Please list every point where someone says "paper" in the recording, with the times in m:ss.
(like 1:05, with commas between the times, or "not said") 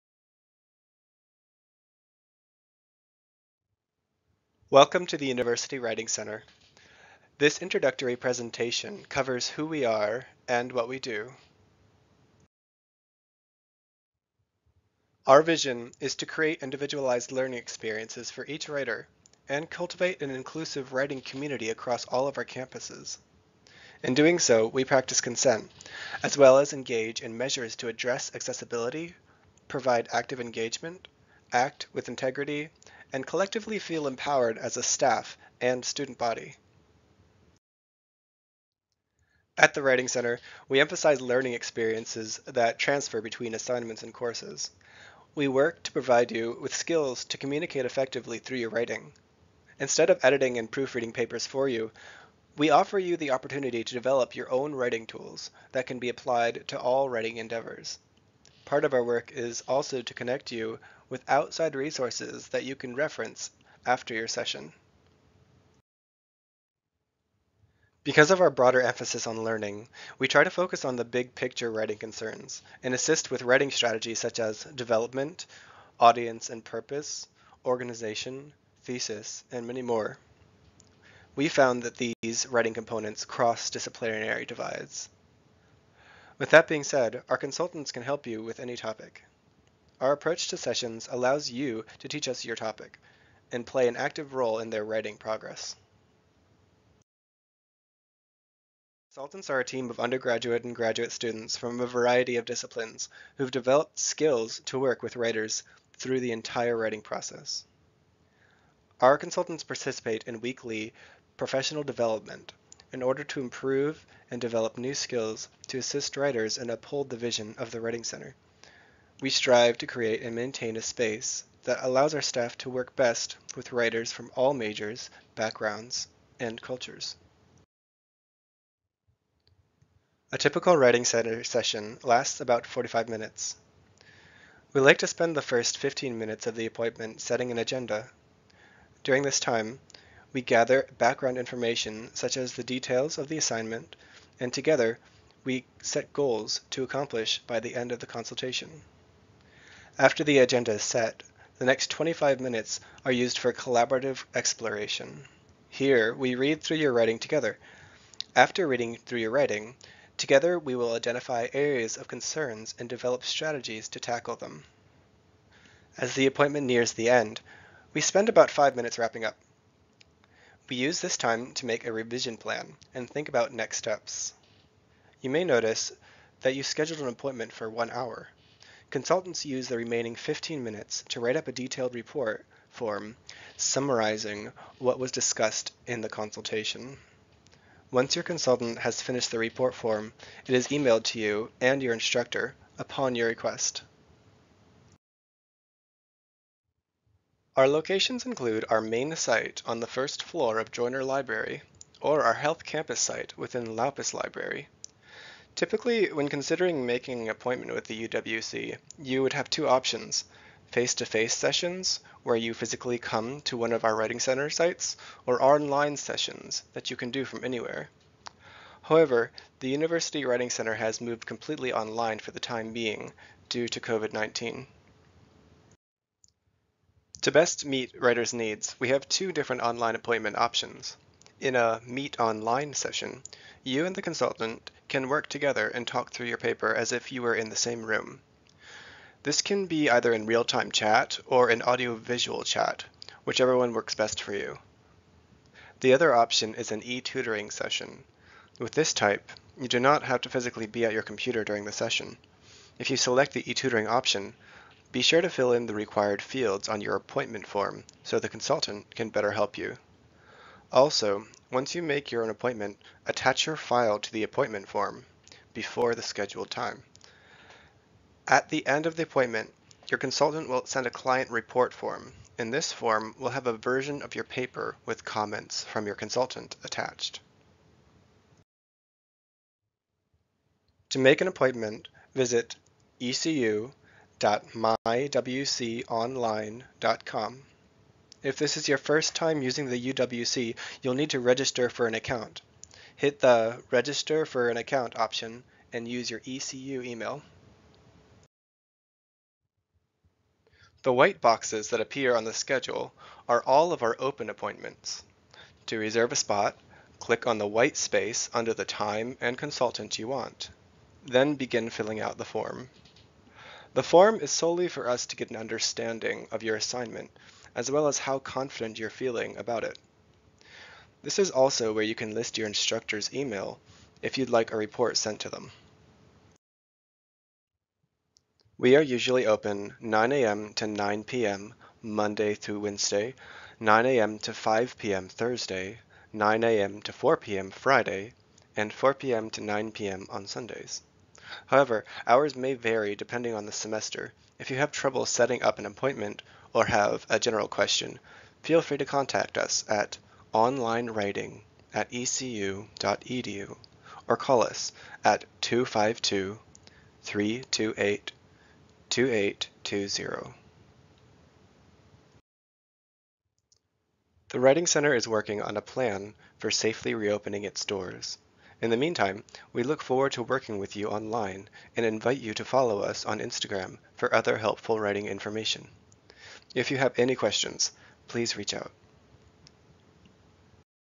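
0:51, 3:56, 4:34.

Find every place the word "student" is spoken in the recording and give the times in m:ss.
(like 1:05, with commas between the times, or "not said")
0:35, 1:41.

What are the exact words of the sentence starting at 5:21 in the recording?
This is also where you can list your instructor's email if you'd like a report sent to them.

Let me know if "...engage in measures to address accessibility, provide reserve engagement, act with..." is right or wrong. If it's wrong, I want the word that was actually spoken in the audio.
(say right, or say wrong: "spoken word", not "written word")
wrong: "active", not "reserve".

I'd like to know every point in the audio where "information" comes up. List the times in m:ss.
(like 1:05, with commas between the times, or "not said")
2:21, 6:15.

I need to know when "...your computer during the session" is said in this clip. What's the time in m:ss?
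4:10.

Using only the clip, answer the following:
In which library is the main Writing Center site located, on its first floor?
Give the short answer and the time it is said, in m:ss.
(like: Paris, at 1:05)
Joyner Library, at 3:20.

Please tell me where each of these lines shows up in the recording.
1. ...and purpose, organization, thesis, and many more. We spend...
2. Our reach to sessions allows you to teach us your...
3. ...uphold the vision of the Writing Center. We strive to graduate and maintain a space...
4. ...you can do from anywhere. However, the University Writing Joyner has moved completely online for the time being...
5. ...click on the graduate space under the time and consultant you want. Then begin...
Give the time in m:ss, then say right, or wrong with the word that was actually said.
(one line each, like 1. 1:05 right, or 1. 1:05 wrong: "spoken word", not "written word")
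1. 1:16 wrong: "found", not "spend"
2. 1:29 wrong: "approach", not "reach"
3. 1:56 wrong: "create", not "graduate"
4. 3:36 wrong: "Center", not "Joyner"
5. 5:06 wrong: "white", not "graduate".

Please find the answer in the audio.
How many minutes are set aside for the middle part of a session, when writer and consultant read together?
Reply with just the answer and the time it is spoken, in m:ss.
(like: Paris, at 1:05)
25, at 2:31.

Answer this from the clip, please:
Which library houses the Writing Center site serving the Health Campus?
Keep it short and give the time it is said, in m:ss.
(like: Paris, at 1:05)
Laupus Library, at 3:23.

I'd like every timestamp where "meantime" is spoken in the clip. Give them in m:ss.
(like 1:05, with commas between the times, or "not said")
6:08.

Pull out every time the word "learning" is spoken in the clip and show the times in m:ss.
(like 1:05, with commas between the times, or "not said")
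0:17, 0:41, 1:09.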